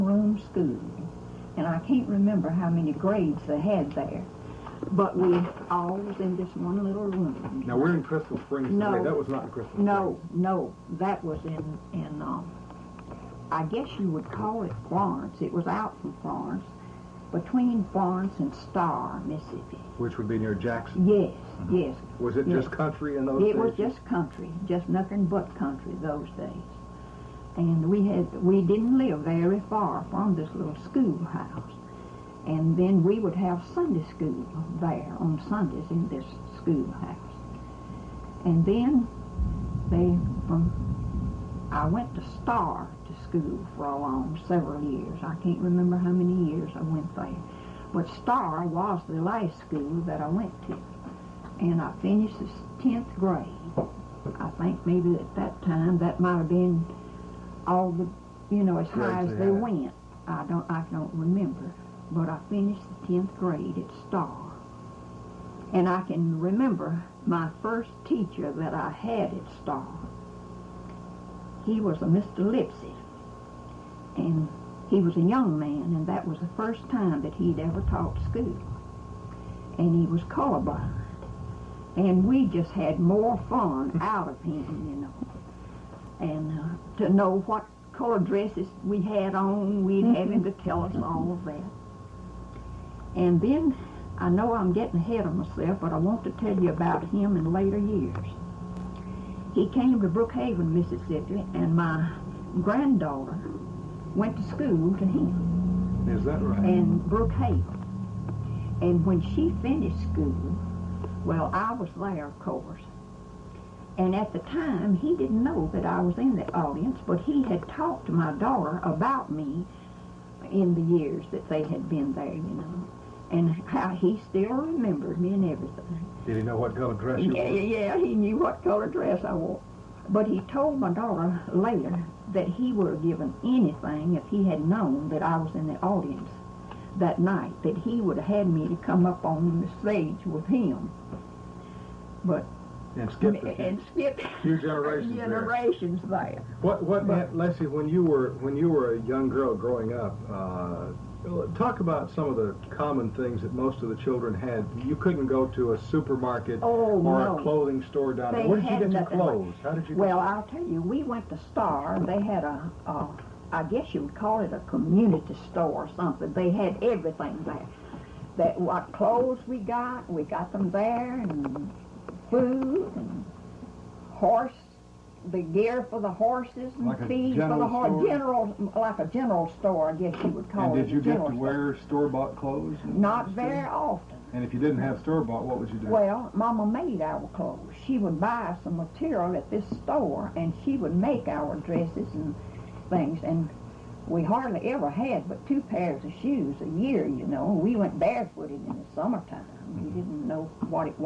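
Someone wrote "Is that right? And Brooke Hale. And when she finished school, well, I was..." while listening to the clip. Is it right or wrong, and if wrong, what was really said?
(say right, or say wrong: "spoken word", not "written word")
right.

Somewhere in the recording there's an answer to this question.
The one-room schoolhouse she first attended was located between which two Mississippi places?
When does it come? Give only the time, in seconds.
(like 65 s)
17 s.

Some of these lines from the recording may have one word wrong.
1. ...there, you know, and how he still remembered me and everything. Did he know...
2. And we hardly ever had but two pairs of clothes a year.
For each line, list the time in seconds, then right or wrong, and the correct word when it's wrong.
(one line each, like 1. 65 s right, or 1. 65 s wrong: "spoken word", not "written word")
1. 122 s right
2. 193 s wrong: "shoes", not "clothes".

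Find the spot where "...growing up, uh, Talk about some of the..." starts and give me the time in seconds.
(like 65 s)
149 s.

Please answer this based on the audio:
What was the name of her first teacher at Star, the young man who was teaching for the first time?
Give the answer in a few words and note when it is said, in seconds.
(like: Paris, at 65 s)
Mr. Lipsy, at 72 s.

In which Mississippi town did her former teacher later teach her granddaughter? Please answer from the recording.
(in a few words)
Brookhaven.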